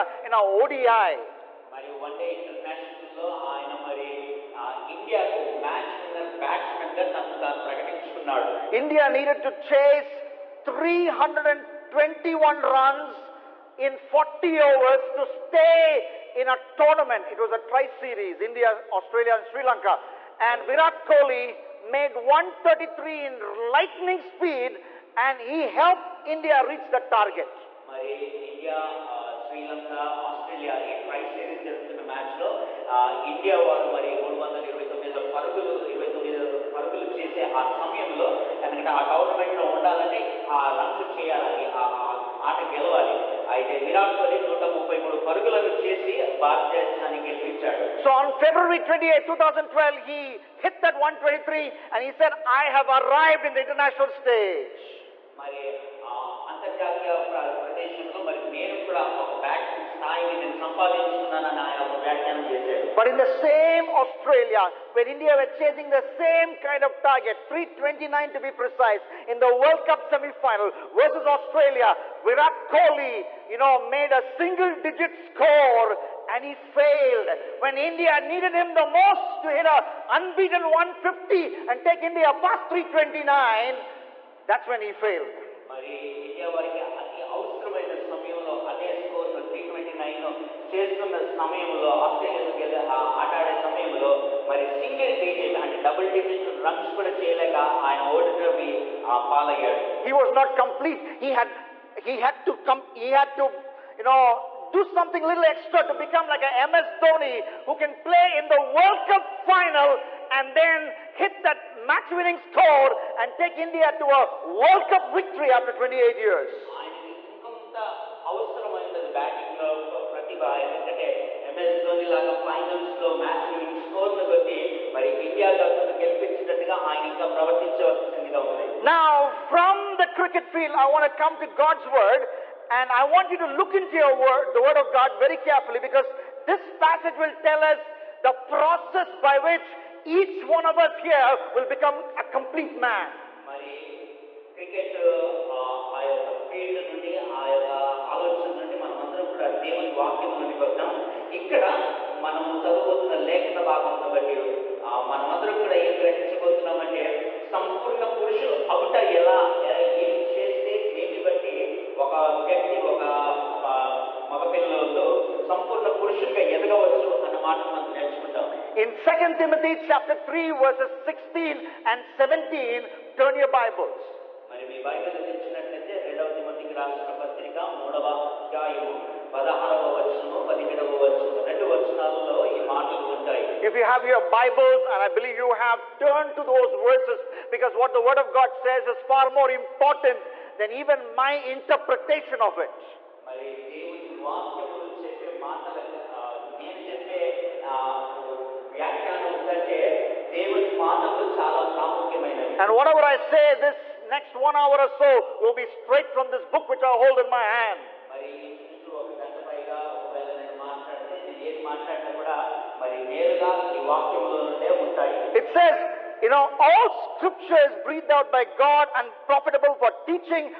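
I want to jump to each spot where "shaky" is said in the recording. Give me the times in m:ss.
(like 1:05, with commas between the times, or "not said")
not said.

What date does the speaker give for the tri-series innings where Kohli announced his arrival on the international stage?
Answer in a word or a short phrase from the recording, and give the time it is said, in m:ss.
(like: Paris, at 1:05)
February 28, 2012, at 0:48.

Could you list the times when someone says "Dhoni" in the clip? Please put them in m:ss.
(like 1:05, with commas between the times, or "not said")
1:47.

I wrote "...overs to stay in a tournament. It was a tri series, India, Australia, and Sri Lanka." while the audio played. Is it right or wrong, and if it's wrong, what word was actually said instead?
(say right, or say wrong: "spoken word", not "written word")
right.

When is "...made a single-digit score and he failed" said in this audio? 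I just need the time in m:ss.
1:13.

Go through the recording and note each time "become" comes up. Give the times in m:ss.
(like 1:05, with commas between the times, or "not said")
1:45, 2:21.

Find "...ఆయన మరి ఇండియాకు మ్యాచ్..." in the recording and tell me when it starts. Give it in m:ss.
0:03.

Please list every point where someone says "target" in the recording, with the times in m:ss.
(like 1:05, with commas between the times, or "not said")
0:27, 1:07.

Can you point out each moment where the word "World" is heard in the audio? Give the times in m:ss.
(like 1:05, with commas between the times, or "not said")
1:09, 1:48, 1:54.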